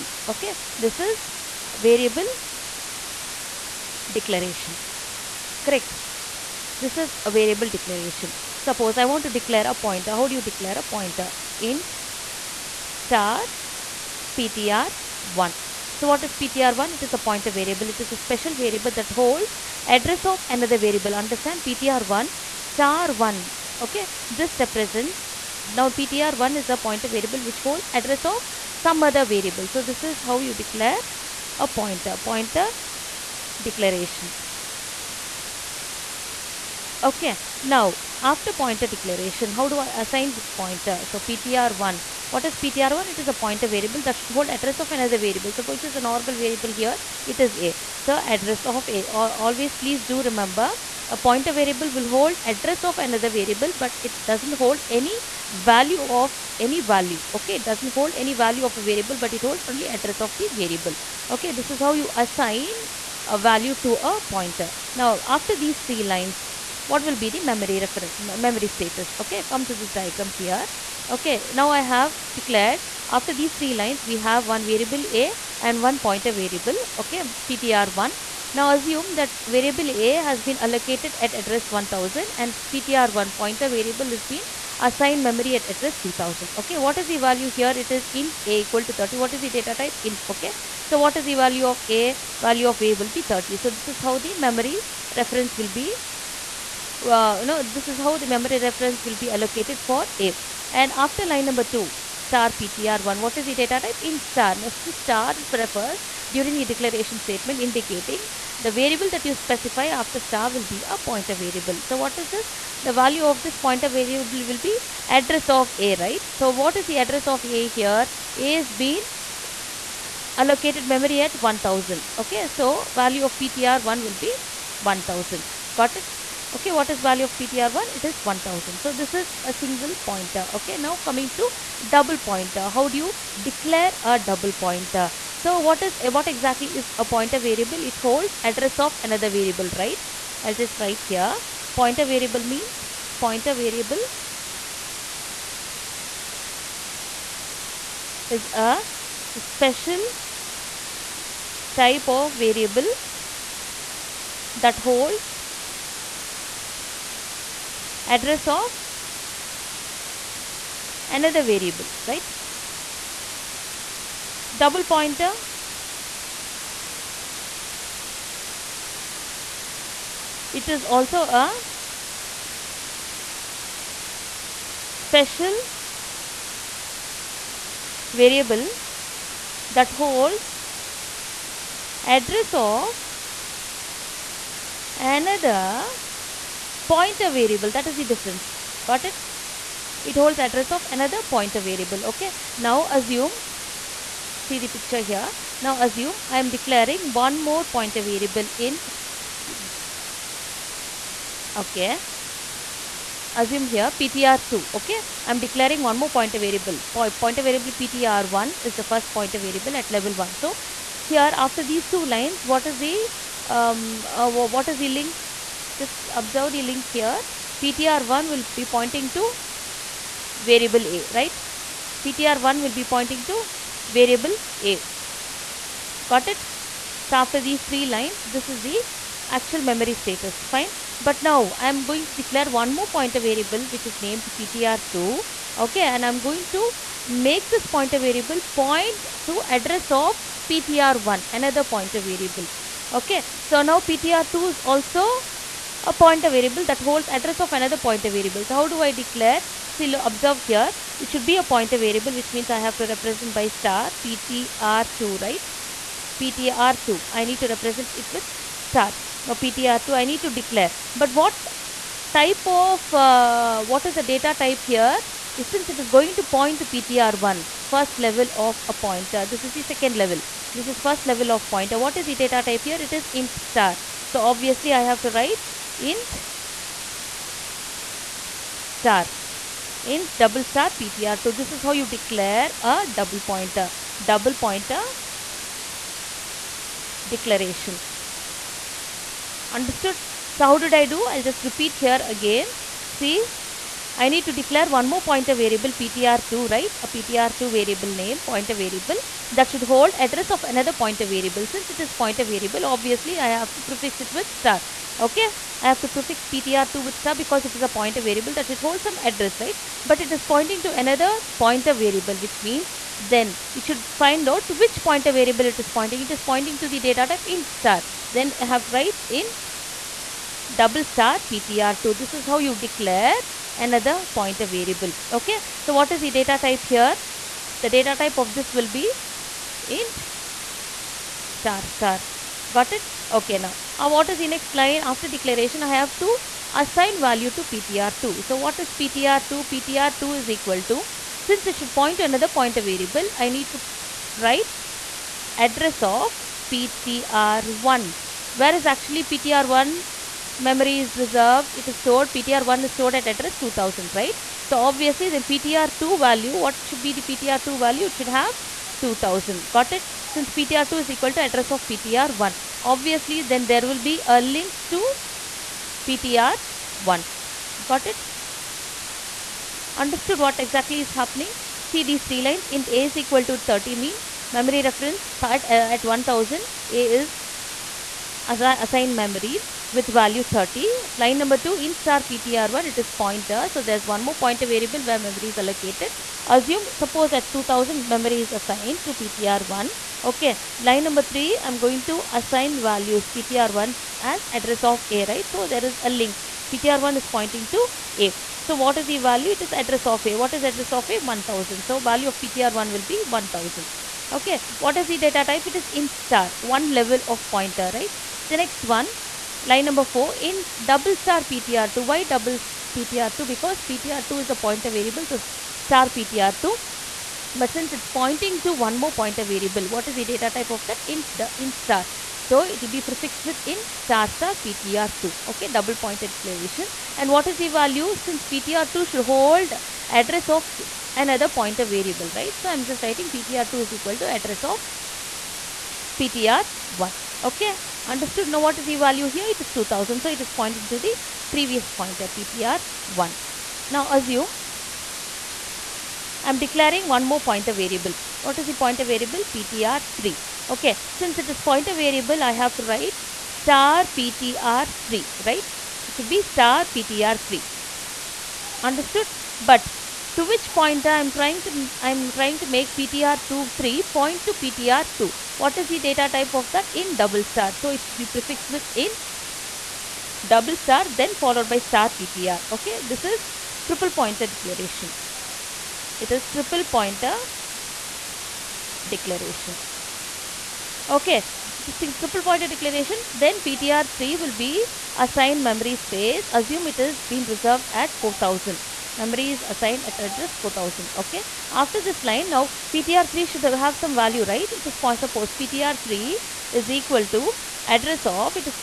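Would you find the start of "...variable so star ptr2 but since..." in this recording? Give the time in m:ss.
6:54.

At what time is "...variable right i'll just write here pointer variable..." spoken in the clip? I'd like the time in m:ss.
2:19.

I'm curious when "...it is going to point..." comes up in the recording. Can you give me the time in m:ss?
4:25.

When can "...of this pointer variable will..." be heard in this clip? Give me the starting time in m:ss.
1:53.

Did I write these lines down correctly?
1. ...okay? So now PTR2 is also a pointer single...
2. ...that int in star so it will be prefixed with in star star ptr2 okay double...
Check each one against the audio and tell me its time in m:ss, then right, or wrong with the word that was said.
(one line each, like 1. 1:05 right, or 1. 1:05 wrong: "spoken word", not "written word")
1. 4:02 wrong: "variable", not "single"
2. 7:00 right.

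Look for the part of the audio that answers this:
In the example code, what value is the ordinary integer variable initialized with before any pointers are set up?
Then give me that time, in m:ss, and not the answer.
1:28.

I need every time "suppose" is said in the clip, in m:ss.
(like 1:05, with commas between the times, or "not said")
0:08, 0:45, 6:26, 8:15.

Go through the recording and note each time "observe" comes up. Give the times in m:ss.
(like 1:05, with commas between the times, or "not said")
3:36, 4:09.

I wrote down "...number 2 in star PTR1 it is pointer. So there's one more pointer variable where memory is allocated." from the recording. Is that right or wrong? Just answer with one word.
right.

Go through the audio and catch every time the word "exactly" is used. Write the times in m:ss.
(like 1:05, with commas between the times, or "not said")
2:16, 6:10.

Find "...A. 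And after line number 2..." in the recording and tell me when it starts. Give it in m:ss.
1:40.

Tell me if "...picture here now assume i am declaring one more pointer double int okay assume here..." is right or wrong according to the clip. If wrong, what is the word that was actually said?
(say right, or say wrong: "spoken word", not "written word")
wrong: "variable", not "double".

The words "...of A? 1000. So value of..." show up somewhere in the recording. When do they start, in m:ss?
6:40.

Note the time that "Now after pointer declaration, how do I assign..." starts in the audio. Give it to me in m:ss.
0:37.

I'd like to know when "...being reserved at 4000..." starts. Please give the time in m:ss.
8:07.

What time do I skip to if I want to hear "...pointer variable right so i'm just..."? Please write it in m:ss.
7:11.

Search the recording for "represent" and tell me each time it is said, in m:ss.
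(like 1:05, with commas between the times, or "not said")
0:24, 4:12, 4:17.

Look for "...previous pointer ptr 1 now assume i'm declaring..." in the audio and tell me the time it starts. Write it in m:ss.
7:21.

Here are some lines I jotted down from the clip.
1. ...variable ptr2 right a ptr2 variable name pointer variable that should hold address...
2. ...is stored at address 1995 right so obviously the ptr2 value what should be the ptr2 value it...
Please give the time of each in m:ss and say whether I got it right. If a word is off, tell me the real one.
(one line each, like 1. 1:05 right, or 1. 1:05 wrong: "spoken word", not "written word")
1. 4:55 right
2. 5:52 wrong: "2000", not "1995".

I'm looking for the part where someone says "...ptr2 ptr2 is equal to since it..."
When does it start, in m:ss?
5:38.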